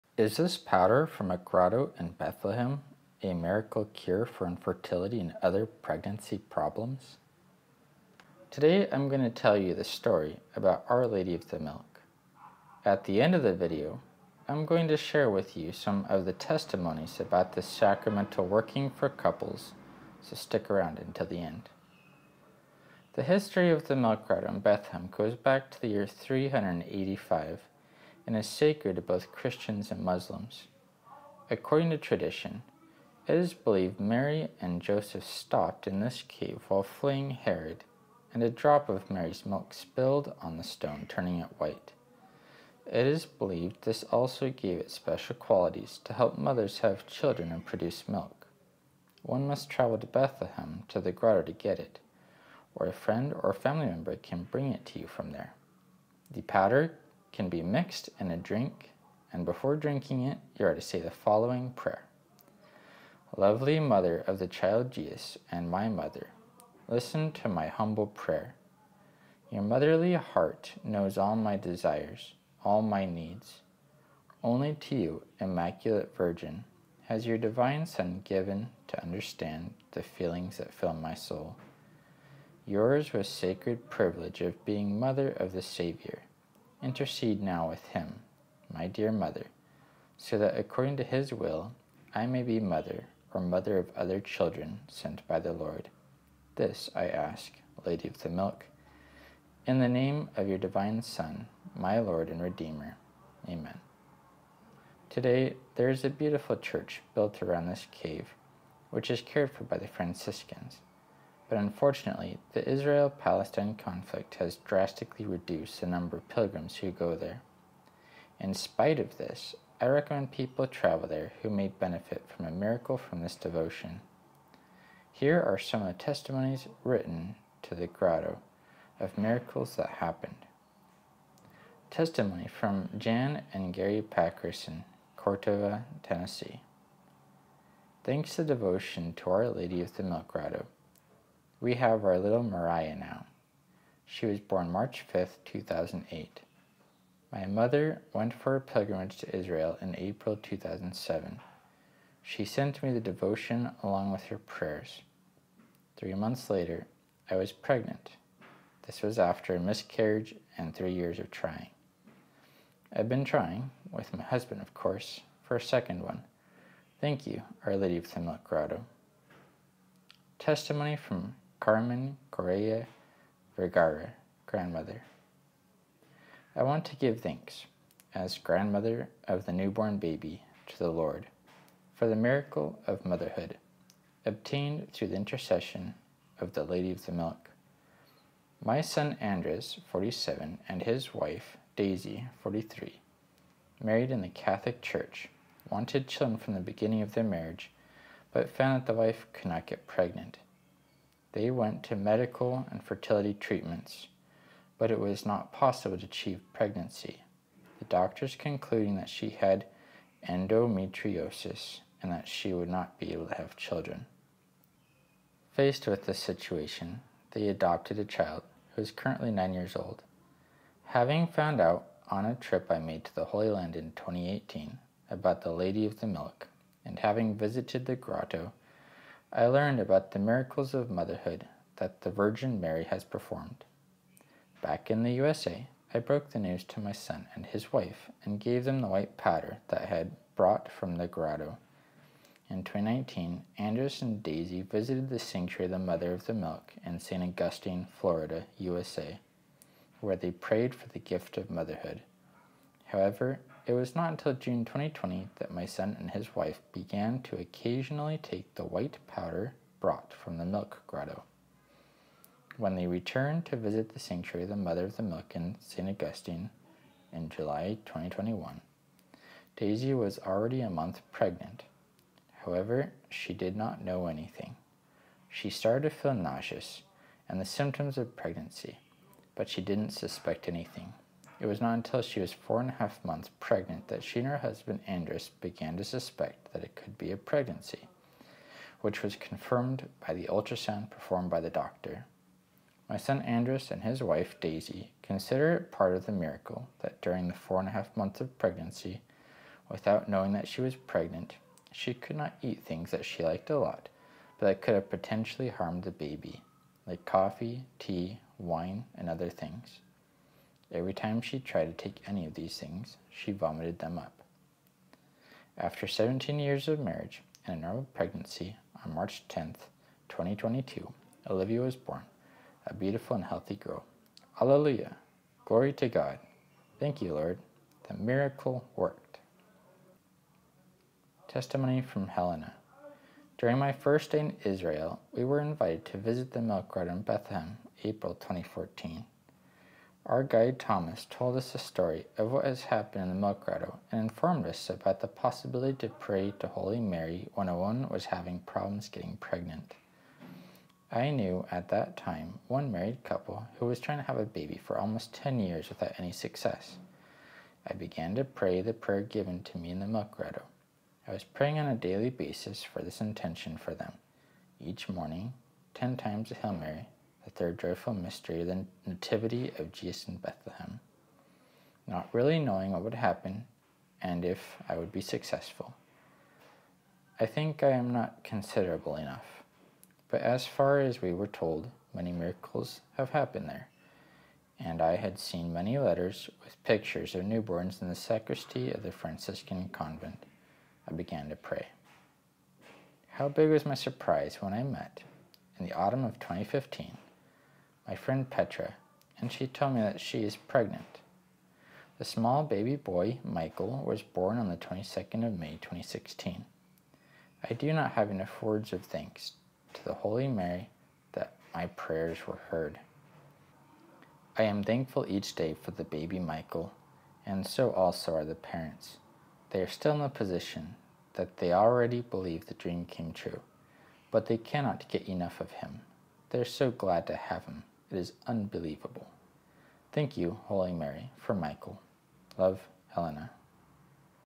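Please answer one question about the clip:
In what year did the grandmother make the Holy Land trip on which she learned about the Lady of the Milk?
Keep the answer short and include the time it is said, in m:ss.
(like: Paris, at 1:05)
2018, at 3:43.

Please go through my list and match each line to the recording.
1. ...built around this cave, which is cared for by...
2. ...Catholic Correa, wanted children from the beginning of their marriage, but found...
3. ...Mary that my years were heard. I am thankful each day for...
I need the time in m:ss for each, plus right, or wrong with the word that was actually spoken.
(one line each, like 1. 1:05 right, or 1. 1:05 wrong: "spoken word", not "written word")
1. 1:47 right
2. 3:14 wrong: "Church", not "Correa"
3. 6:50 wrong: "prayers", not "years".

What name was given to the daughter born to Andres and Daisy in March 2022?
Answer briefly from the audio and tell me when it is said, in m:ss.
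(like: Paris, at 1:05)
Olivia, at 5:21.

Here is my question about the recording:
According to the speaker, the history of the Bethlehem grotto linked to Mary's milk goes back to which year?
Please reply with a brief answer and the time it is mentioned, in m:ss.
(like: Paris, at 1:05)
385, at 0:26.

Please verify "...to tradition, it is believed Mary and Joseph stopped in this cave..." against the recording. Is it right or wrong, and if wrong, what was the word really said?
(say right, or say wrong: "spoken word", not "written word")
right.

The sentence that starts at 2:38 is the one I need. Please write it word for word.
This was after a miscarriage and three years of trying.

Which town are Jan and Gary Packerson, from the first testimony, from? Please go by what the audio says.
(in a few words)
Cordova, Tennessee.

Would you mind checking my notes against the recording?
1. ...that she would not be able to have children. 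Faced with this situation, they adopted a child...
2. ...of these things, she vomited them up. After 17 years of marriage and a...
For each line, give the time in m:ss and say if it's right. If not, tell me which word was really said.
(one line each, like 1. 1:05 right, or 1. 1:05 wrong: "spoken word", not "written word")
1. 3:32 right
2. 5:12 right.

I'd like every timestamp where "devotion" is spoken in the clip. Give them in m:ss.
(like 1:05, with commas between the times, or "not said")
2:03, 2:18, 2:32.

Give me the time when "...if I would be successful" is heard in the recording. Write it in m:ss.
6:14.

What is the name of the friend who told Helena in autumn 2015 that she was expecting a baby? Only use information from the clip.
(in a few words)
Petra.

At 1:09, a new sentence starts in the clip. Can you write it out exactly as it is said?
Your motherly heart knows all my desires, all my needs.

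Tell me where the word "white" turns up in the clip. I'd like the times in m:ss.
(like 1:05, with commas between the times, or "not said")
0:41, 3:58, 4:18.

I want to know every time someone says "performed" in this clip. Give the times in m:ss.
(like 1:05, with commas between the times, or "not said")
3:53, 4:50.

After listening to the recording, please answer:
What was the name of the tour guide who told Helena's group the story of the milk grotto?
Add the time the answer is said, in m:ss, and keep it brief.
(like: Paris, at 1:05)
Thomas, at 5:40.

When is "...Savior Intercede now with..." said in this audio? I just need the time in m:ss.
1:25.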